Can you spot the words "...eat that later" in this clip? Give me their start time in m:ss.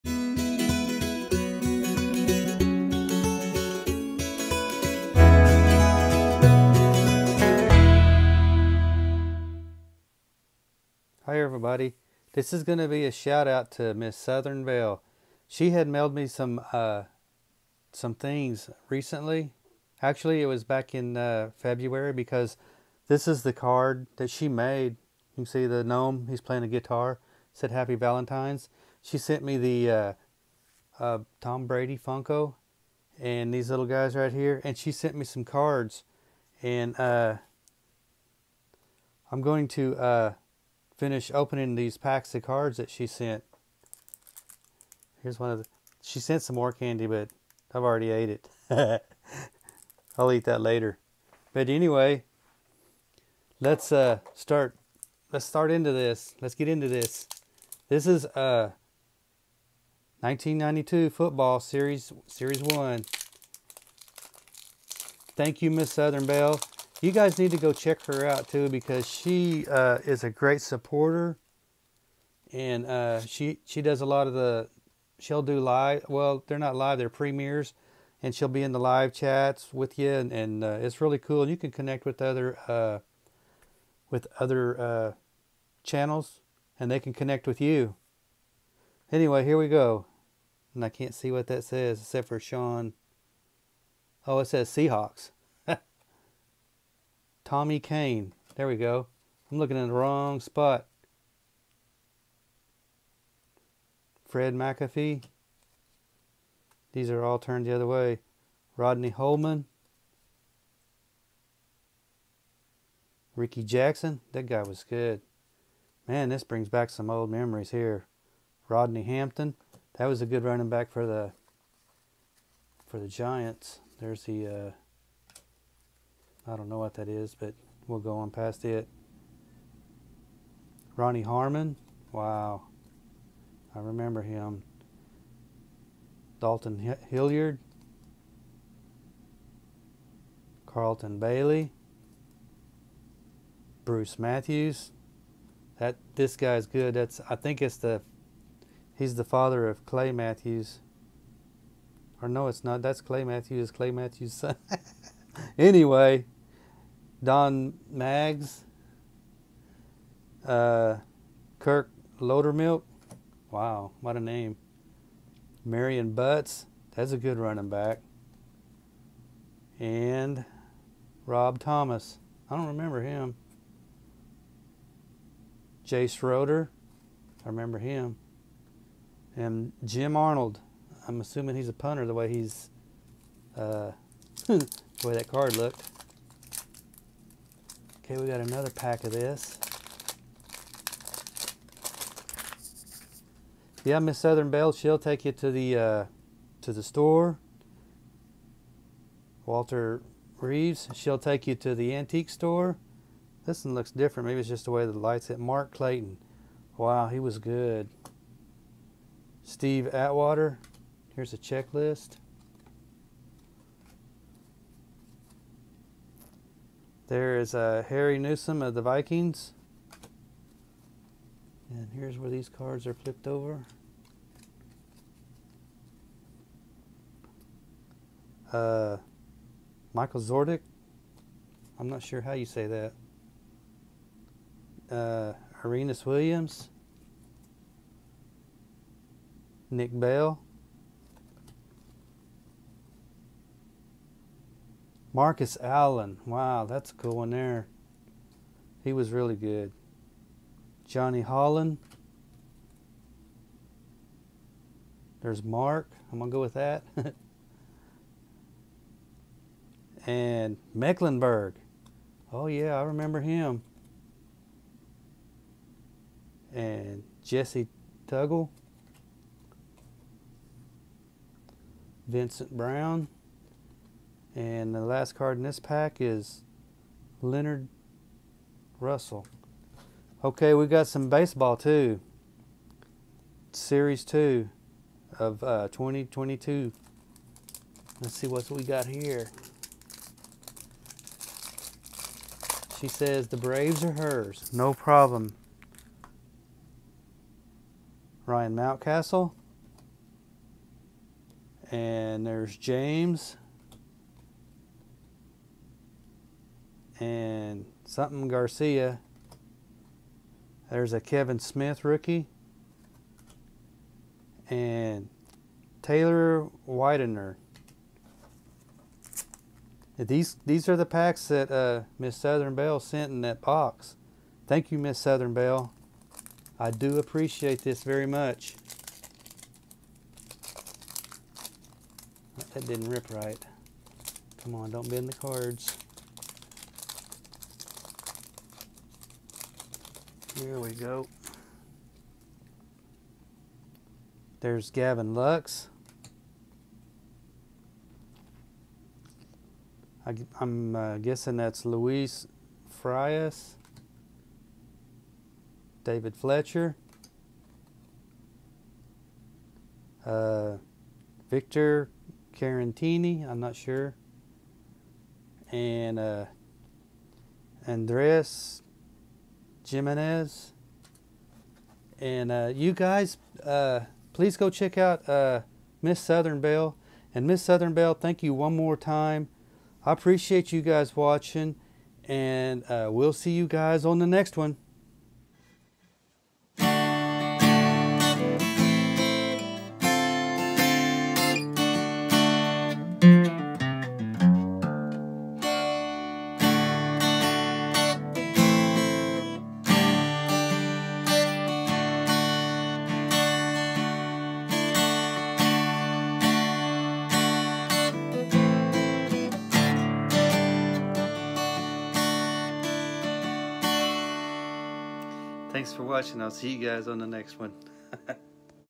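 0:50.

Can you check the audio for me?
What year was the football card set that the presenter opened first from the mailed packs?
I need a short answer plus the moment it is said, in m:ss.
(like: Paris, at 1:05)
1992, at 1:00.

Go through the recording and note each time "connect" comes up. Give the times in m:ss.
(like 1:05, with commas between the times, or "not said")
1:21, 1:27.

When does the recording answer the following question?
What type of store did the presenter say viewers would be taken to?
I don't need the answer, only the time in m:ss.
3:21.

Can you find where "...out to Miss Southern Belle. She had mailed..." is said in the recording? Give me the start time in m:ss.
0:13.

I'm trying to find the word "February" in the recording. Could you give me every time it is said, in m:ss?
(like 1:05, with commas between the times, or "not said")
0:21.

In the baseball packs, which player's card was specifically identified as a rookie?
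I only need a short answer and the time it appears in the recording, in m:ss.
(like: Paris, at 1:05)
Kevin Smith, at 5:11.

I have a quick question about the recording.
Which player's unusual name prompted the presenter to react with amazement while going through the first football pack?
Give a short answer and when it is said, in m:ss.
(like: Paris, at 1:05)
Kirk Lowdermilk, at 2:41.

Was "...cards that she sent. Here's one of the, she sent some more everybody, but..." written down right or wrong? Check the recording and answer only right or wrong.
wrong.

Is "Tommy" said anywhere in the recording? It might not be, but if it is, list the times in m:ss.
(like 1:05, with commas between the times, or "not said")
1:37.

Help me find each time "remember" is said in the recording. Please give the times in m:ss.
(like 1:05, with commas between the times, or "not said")
2:13, 2:52, 2:57, 4:22.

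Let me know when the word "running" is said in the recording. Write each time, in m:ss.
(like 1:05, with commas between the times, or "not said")
2:00, 2:47.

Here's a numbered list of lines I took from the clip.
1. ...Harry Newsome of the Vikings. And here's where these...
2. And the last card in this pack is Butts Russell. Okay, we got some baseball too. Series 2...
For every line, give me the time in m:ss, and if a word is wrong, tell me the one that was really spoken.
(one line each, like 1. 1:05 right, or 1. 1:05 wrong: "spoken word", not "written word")
1. 3:37 right
2. 4:34 wrong: "Leonard", not "Butts".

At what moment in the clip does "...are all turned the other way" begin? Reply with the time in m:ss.
1:47.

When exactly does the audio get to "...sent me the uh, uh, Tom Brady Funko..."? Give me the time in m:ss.
0:29.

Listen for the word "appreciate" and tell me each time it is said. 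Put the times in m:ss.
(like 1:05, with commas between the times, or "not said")
5:26, 6:19.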